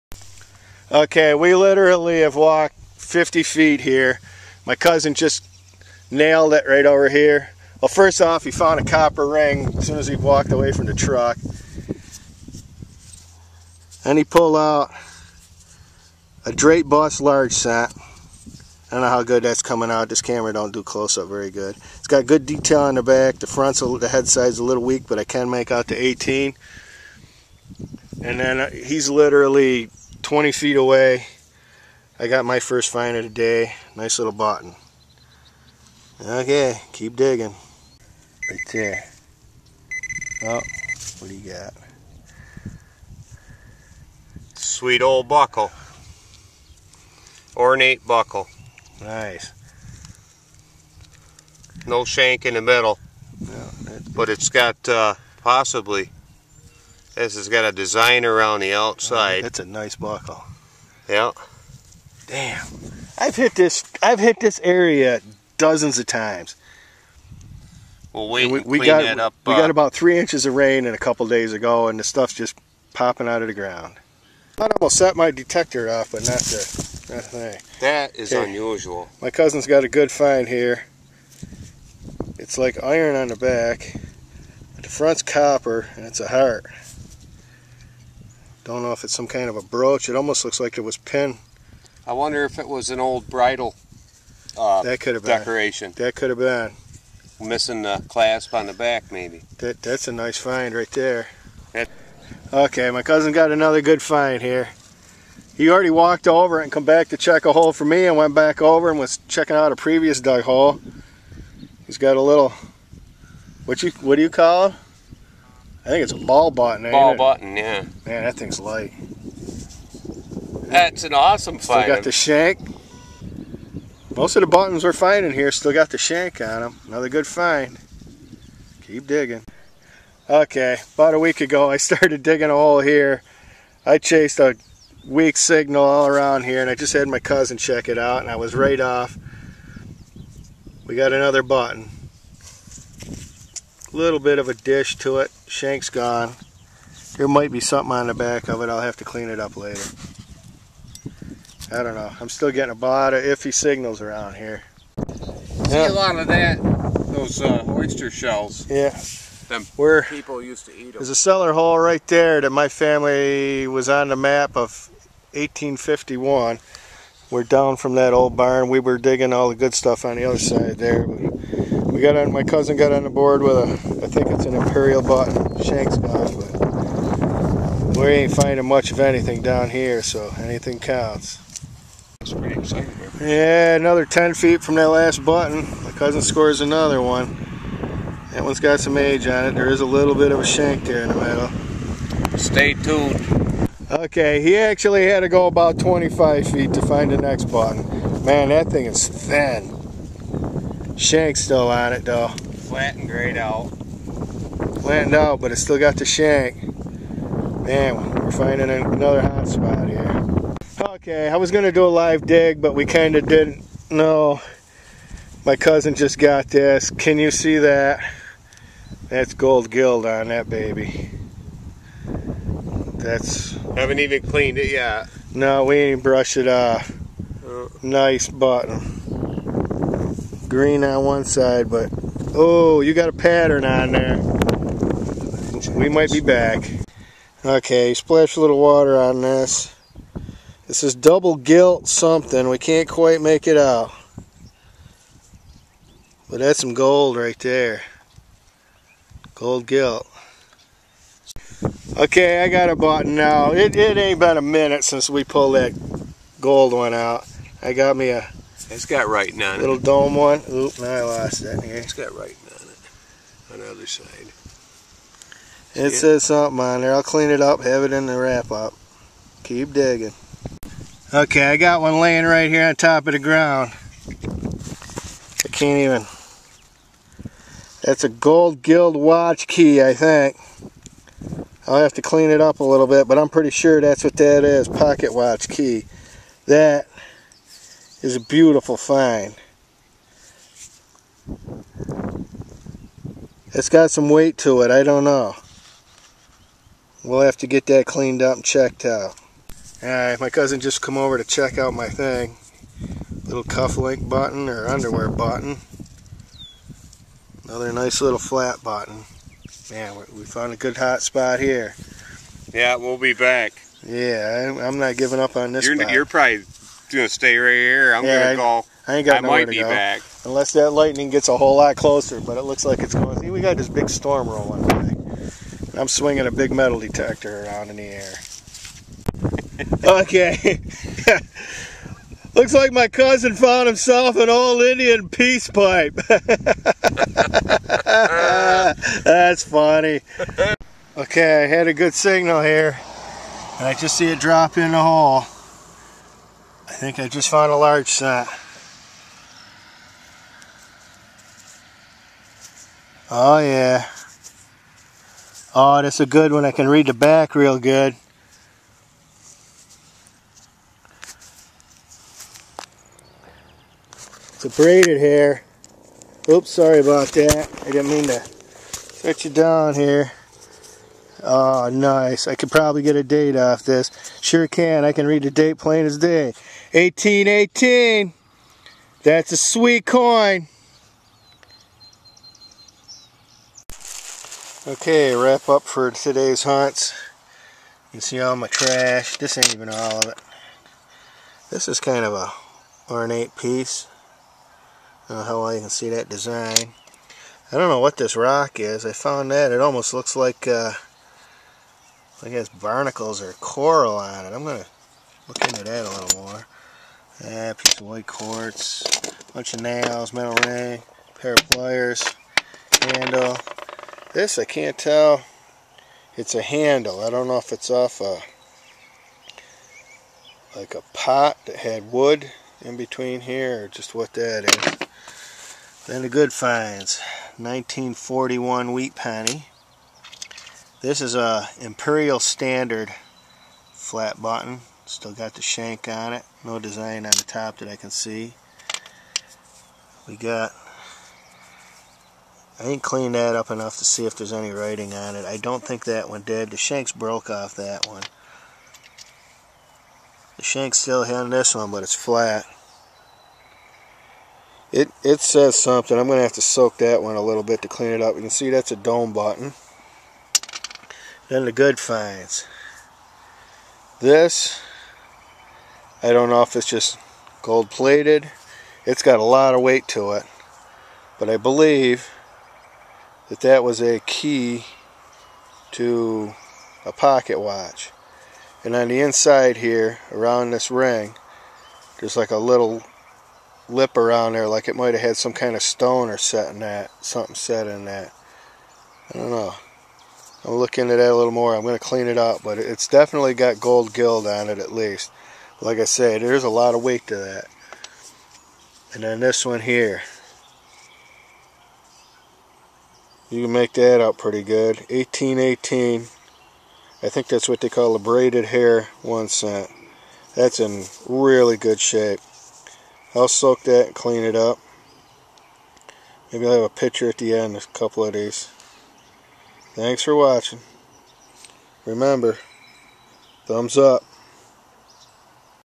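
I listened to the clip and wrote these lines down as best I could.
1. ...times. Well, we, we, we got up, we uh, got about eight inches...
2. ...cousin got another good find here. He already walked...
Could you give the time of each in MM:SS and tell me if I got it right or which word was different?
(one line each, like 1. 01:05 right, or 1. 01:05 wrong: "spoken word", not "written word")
1. 01:06 wrong: "three", not "eight"
2. 01:43 right.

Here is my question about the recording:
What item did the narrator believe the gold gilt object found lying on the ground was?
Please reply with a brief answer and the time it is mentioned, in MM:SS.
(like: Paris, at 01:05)
pocket watch key, at 04:44.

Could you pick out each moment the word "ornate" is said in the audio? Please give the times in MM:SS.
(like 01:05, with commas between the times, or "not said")
00:47, 06:32.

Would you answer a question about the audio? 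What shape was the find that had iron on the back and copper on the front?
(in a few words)
heart.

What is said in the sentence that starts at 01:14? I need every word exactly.
I almost set my detector off, but not the, not the thing.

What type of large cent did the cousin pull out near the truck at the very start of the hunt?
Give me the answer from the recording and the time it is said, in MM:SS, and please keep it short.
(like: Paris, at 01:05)
draped bust, at 00:16.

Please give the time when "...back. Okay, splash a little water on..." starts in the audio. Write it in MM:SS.
03:56.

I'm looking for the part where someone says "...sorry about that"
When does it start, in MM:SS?
06:06.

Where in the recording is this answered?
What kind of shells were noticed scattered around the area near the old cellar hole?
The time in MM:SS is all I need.
02:37.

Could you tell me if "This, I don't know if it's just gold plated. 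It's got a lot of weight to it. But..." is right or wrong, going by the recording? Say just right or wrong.
right.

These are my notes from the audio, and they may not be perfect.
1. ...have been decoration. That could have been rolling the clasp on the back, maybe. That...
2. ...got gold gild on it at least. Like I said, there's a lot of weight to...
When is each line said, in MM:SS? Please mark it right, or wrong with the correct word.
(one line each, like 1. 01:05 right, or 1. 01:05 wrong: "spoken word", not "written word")
1. 01:35 wrong: "missing", not "rolling"
2. 08:13 right.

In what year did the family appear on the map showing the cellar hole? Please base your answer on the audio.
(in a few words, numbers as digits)
1851.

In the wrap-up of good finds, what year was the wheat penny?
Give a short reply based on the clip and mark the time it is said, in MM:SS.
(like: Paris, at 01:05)
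1941, at 07:07.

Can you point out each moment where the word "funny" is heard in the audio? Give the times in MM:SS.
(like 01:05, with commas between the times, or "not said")
05:39.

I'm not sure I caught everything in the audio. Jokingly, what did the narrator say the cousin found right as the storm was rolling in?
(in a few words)
Indian peace pipe.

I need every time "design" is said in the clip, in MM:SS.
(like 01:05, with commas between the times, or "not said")
00:57, 06:36, 07:16.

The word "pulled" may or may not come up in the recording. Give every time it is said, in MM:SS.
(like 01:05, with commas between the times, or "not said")
00:14, 04:15.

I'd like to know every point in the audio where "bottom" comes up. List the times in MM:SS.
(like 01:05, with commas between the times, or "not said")
00:34, 03:48.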